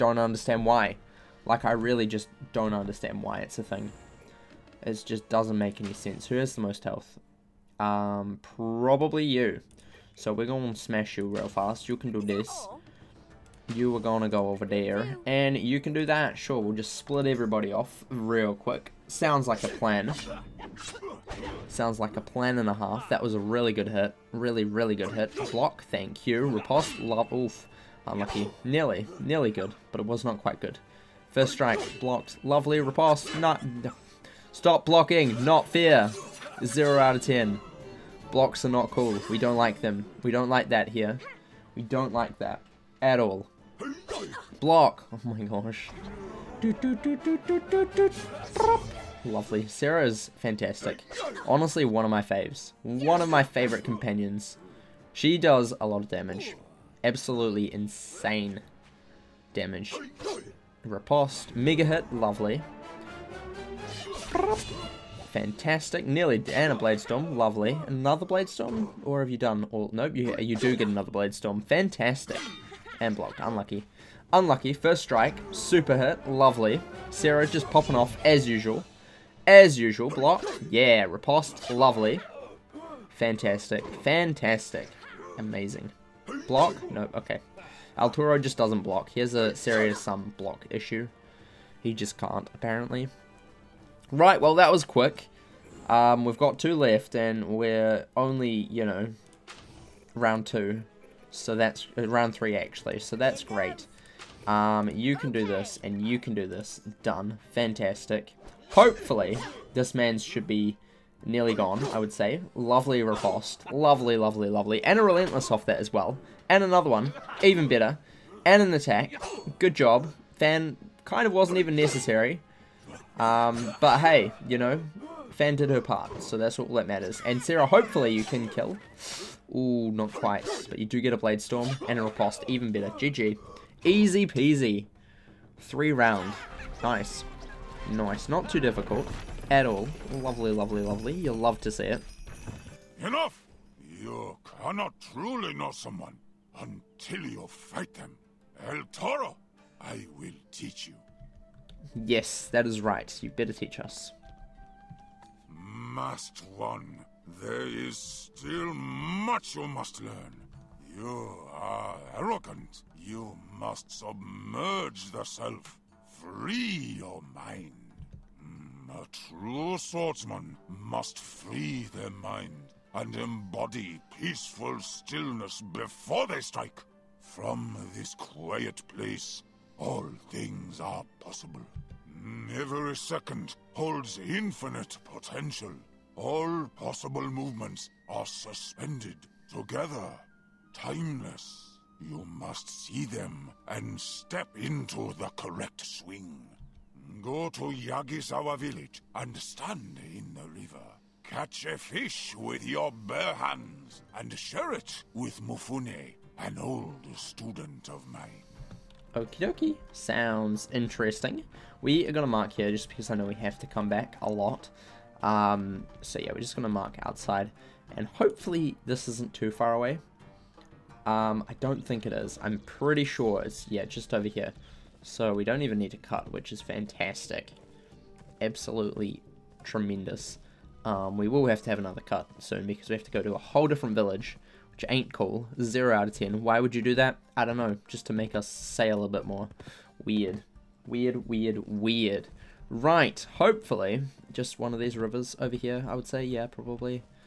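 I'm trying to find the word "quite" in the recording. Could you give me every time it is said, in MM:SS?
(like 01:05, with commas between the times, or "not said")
00:30, 02:10.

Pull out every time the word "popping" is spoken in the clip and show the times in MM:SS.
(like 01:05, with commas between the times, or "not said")
01:17.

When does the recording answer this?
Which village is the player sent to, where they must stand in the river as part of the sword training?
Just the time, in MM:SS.
03:17.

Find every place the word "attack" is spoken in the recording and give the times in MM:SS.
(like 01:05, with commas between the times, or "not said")
01:58.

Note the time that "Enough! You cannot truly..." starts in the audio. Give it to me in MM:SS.
02:22.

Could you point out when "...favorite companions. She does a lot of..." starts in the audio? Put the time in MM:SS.
00:53.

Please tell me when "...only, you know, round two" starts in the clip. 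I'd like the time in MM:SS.
01:38.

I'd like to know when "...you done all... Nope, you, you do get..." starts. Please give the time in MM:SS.
01:09.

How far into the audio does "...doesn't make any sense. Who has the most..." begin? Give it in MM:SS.
00:05.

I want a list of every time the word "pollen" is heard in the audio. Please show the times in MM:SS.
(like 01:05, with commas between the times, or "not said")
not said.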